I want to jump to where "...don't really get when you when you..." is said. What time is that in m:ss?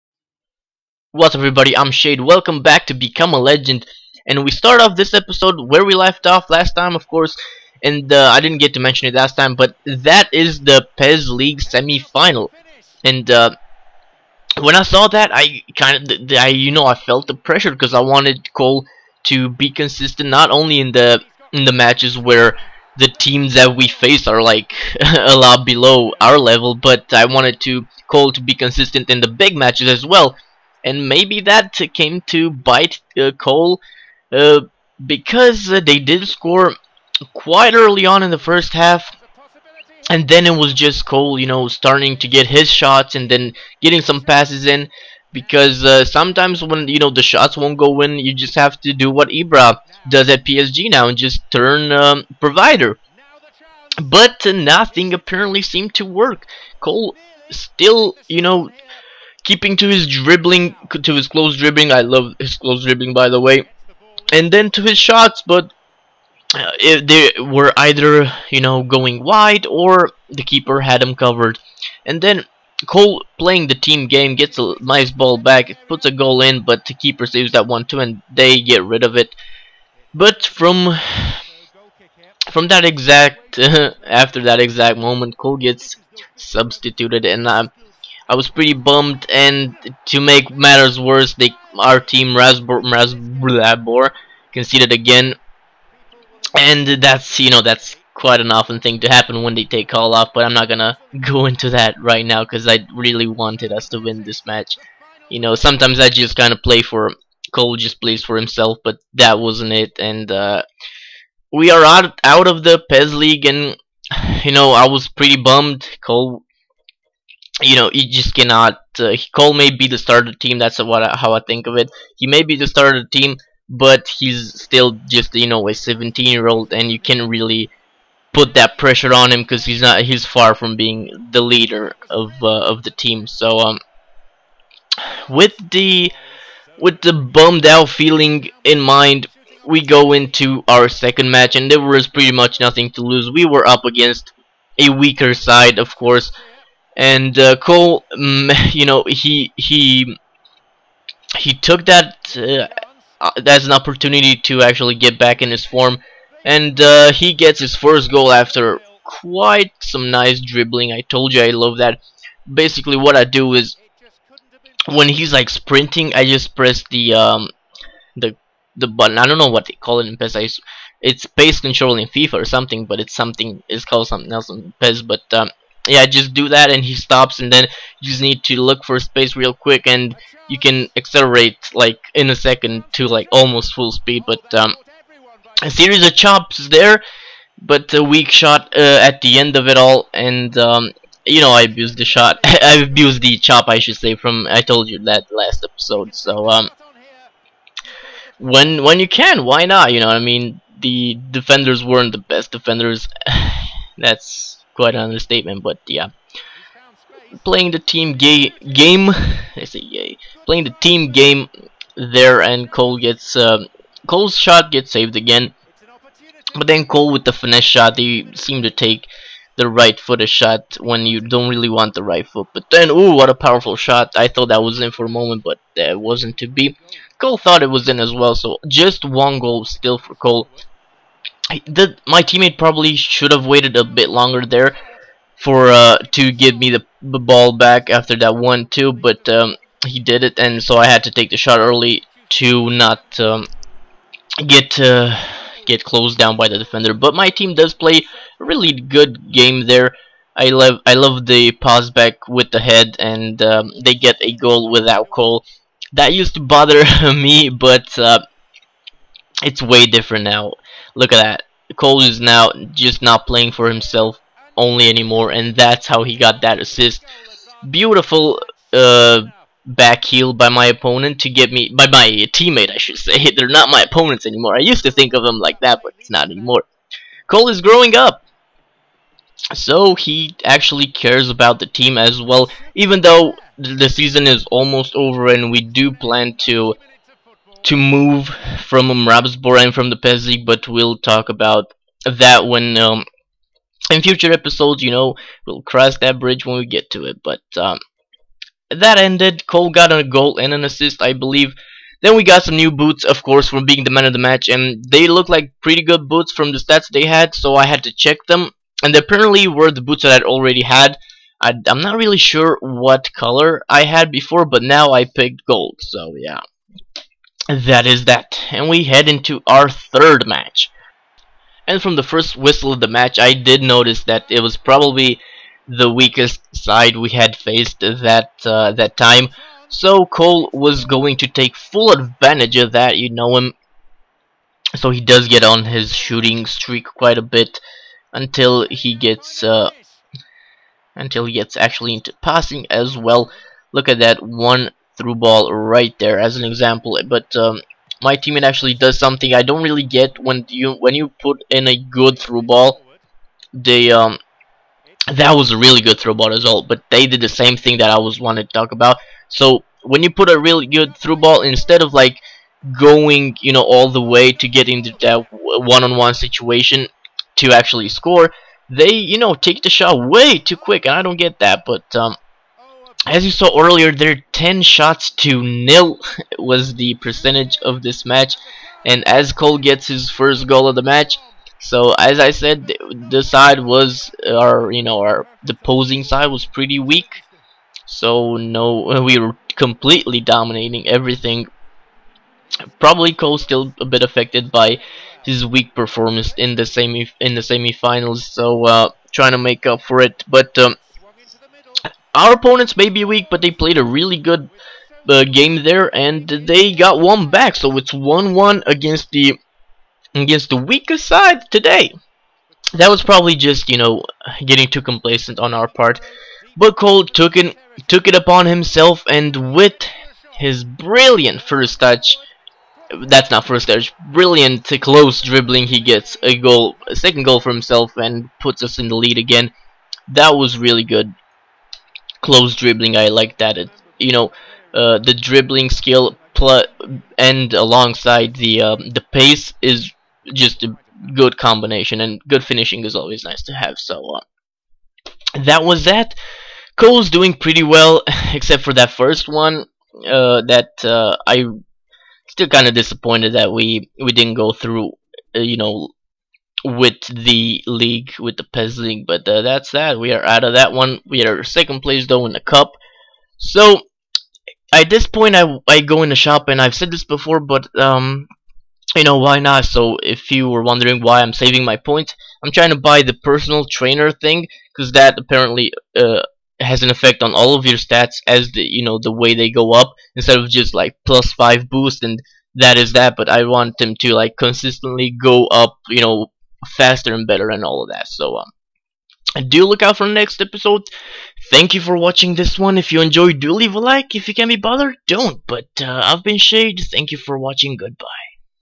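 5:49.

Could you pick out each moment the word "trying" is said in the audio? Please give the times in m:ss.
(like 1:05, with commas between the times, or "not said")
6:39, 7:52.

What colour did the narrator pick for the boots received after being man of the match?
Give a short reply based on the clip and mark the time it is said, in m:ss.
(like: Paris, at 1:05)
gold, at 5:15.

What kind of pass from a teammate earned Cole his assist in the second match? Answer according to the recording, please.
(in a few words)
back heel.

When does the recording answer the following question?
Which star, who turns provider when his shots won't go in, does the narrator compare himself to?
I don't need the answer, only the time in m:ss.
0:49.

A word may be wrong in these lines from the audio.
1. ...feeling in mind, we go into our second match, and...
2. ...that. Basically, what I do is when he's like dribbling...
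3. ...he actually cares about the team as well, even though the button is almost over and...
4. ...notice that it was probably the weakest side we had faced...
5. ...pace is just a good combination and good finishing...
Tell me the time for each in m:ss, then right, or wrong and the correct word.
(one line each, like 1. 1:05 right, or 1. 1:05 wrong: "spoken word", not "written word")
1. 2:17 right
2. 2:41 wrong: "sprinting", not "dribbling"
3. 4:39 wrong: "season", not "button"
4. 5:23 right
5. 7:19 right.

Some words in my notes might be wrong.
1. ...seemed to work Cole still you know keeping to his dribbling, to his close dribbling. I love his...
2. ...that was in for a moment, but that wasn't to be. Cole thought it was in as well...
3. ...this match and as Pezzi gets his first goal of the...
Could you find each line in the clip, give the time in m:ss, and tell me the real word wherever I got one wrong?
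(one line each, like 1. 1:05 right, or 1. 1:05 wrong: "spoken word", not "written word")
1. 0:55 right
2. 3:44 right
3. 6:17 wrong: "Cole", not "Pezzi".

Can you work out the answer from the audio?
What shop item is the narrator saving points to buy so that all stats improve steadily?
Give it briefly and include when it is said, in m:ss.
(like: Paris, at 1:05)
personal trainer, at 7:53.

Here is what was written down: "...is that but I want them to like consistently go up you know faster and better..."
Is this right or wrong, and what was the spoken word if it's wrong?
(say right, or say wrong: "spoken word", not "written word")
right.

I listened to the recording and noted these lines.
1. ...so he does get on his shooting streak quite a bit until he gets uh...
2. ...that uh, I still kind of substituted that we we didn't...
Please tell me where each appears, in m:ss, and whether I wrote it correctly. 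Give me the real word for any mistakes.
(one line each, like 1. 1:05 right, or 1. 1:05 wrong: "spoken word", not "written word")
1. 5:34 right
2. 7:30 wrong: "disappointed", not "substituted".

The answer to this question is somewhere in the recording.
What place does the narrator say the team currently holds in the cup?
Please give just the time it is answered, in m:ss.
7:41.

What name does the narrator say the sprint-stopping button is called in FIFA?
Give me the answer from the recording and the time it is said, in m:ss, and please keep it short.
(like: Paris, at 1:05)
pace control, at 2:51.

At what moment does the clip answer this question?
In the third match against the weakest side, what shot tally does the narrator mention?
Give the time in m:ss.
6:14.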